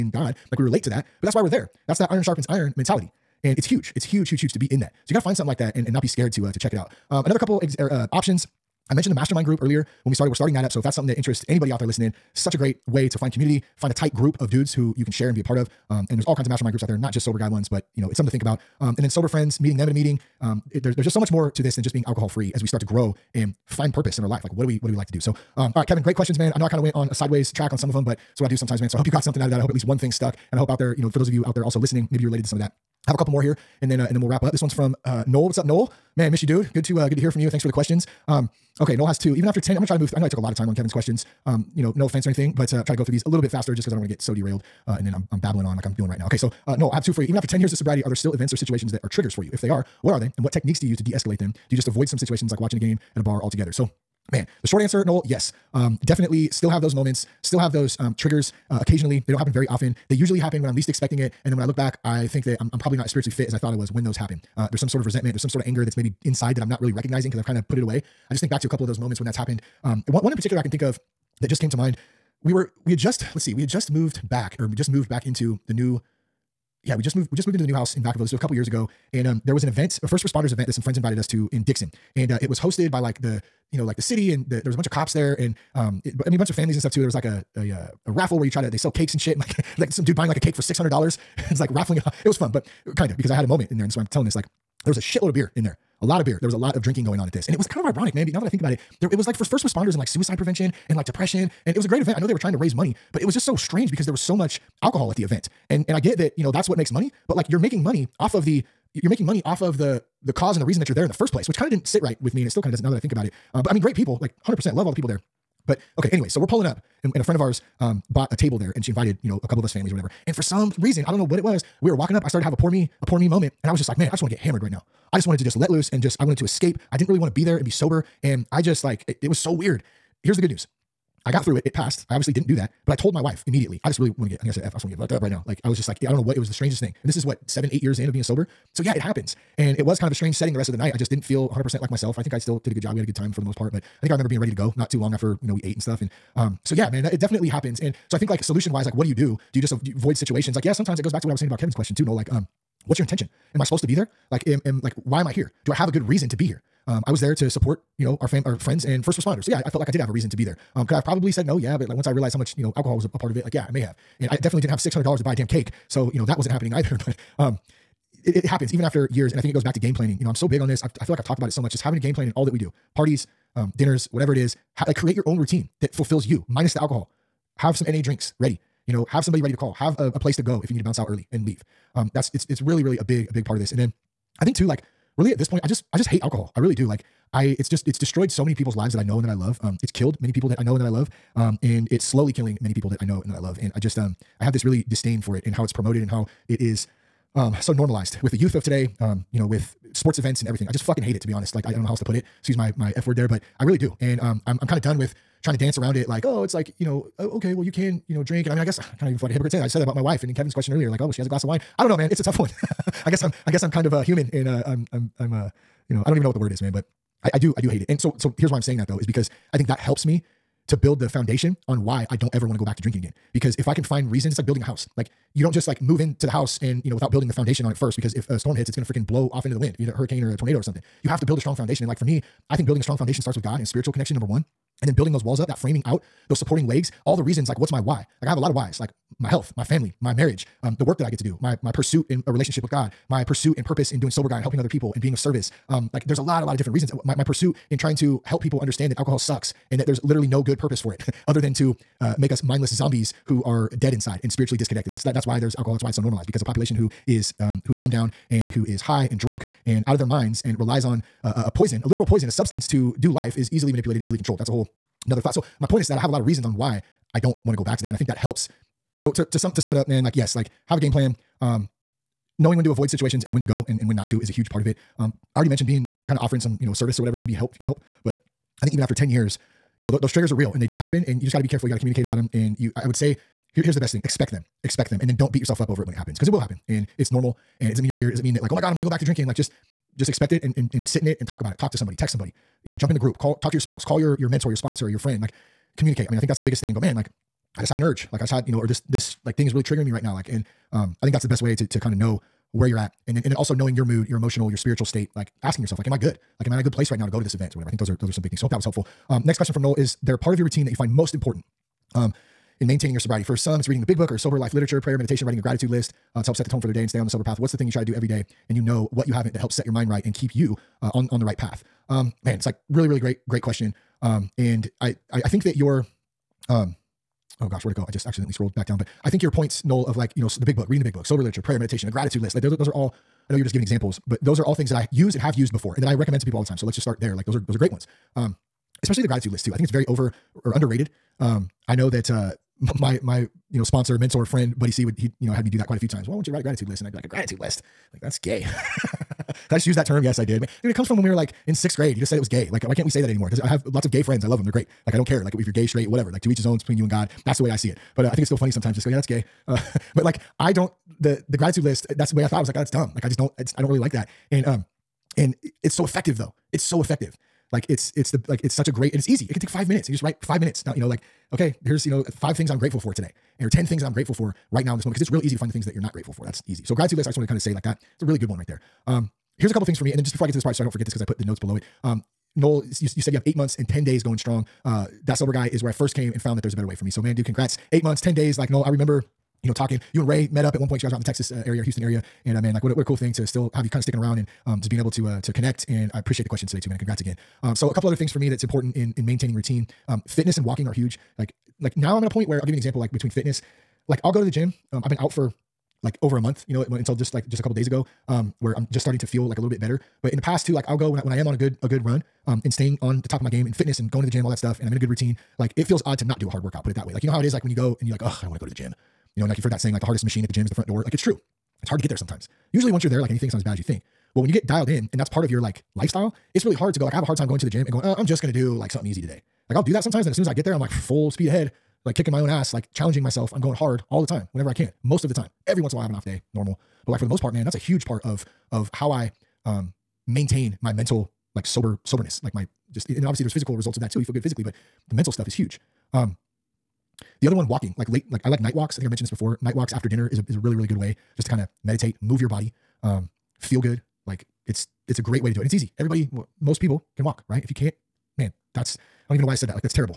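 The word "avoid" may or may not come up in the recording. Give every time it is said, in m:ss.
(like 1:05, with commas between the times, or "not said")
0:51, 2:29, 4:32.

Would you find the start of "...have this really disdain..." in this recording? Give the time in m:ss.
3:14.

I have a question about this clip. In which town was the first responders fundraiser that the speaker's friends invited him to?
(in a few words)
Dixon.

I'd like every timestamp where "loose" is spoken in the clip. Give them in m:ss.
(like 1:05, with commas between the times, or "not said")
2:05.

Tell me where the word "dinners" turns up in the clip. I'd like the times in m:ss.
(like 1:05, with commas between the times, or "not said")
2:53, 7:29.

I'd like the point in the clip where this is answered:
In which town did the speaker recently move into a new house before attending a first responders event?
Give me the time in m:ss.
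1:18.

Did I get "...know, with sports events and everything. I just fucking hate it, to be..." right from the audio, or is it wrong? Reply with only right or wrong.
right.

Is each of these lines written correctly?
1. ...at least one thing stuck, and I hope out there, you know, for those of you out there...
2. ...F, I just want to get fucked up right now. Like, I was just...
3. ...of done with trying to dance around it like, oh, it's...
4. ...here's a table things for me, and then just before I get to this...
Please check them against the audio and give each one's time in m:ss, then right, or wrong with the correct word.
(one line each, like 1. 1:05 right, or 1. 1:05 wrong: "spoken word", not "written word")
1. 0:29 right
2. 2:14 right
3. 3:24 right
4. 6:19 wrong: "couple", not "table".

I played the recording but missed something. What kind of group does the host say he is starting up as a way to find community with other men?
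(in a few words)
mastermind group.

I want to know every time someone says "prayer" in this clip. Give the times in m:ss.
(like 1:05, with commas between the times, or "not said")
5:14, 5:31.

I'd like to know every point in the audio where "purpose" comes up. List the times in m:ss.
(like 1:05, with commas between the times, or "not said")
0:23, 4:03, 4:10.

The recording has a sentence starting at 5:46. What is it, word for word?
Well, I want you to write a gratitude list, and I'd be like a gratitude list like, that's gay.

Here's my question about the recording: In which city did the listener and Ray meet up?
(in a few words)
Houston.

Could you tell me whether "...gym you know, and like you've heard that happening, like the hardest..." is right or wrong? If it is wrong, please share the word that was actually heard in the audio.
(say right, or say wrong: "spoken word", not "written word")
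wrong: "saying", not "happening".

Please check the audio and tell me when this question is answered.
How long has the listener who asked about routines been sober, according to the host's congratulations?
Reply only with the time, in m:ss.
6:27.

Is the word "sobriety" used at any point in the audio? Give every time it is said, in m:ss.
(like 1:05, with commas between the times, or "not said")
0:47, 5:12.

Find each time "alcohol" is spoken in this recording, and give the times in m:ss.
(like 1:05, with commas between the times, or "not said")
0:22, 1:44, 2:42, 2:56, 3:06, 4:08, 4:15.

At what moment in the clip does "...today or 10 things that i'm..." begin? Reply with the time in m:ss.
6:12.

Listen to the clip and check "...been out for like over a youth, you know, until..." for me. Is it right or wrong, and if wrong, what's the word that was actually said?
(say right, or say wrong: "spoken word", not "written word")
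wrong: "month", not "youth".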